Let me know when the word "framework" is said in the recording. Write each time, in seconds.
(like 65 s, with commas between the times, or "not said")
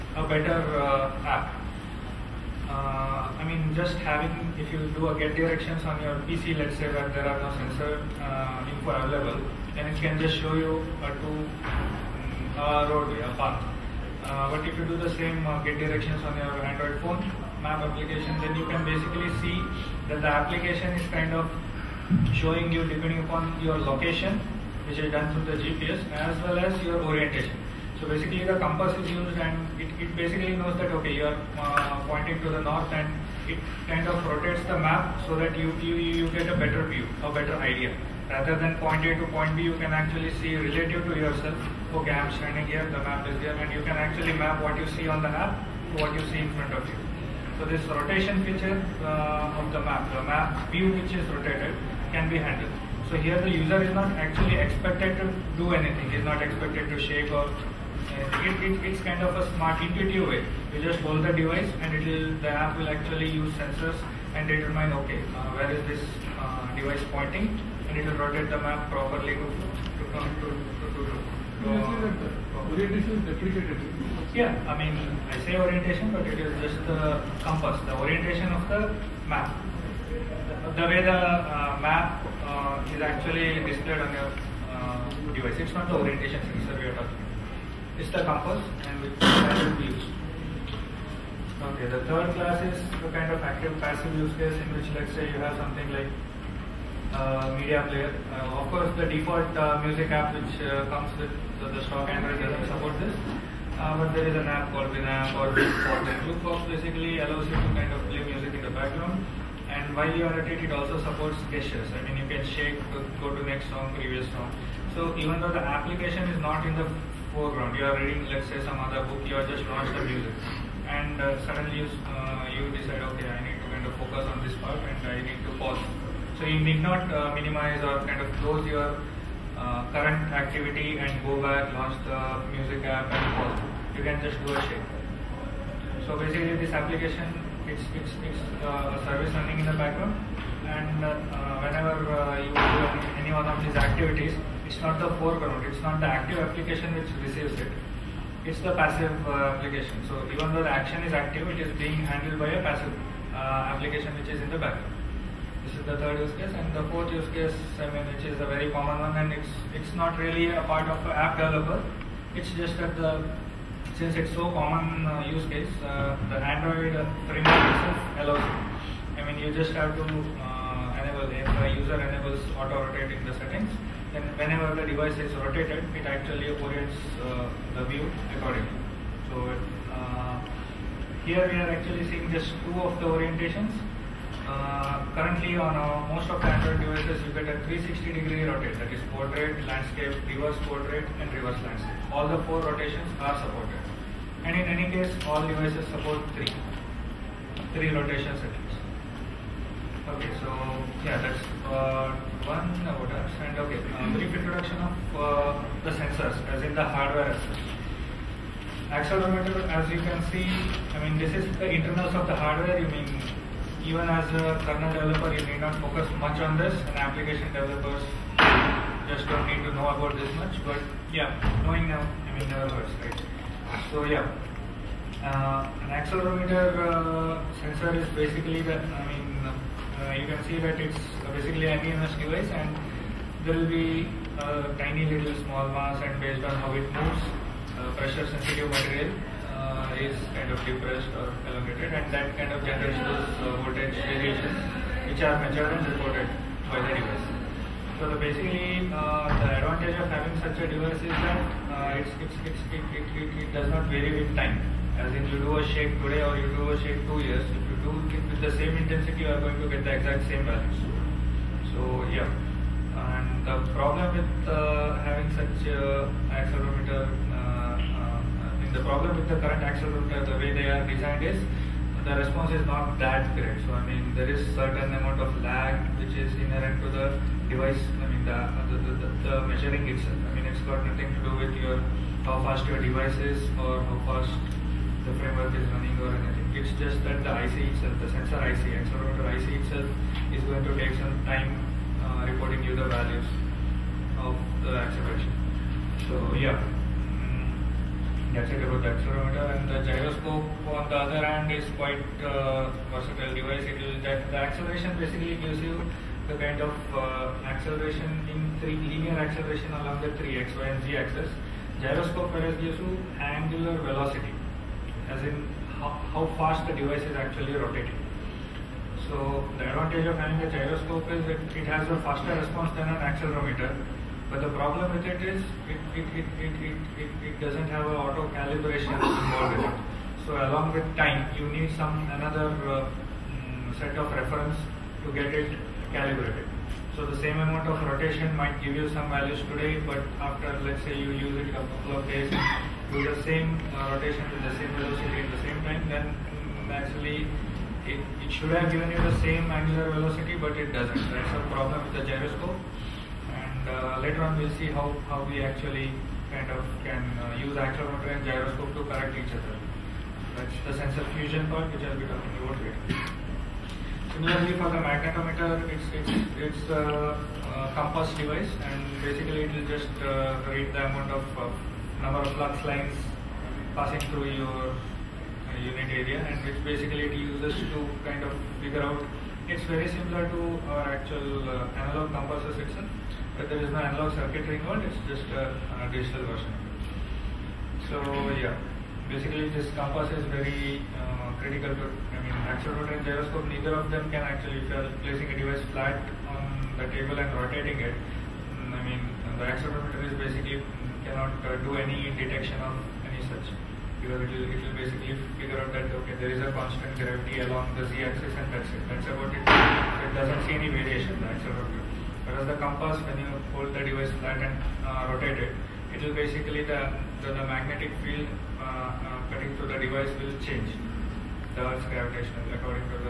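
167 s, 285 s.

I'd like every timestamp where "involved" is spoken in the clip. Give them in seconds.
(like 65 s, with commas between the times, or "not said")
328 s, 384 s.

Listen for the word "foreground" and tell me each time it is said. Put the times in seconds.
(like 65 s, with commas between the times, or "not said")
117 s, 145 s.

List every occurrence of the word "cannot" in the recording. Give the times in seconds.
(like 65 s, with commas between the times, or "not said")
401 s.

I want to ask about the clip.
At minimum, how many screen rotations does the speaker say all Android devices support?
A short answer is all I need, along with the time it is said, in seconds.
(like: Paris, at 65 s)
3, at 197 s.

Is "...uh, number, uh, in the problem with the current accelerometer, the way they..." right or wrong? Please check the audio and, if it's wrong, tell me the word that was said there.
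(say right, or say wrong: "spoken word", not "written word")
wrong: "accelerometer", not "number".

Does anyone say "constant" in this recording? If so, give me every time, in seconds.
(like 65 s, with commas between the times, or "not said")
406 s.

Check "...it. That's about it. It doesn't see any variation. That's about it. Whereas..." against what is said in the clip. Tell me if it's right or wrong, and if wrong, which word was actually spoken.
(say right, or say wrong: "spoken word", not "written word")
right.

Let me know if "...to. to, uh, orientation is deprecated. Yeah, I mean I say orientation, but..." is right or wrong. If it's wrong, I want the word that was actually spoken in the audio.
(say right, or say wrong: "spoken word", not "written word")
right.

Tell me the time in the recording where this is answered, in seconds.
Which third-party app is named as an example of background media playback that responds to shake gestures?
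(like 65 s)
104 s.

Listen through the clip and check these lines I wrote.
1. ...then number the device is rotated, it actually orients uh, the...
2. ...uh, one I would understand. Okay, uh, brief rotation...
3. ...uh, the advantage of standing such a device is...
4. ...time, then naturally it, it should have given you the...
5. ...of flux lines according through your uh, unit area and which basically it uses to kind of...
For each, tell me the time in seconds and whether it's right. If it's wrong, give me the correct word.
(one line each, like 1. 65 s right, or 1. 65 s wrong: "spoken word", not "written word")
1. 174 s wrong: "whenever", not "number"
2. 201 s wrong: "introduction", not "rotation"
3. 248 s wrong: "having", not "standing"
4. 345 s right
5. 372 s wrong: "passing", not "according".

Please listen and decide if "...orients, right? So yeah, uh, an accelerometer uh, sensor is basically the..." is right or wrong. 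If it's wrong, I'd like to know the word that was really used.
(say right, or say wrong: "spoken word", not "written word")
wrong: "hurts", not "orients".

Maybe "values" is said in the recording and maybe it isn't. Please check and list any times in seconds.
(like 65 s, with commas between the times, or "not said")
260 s, 292 s, 339 s.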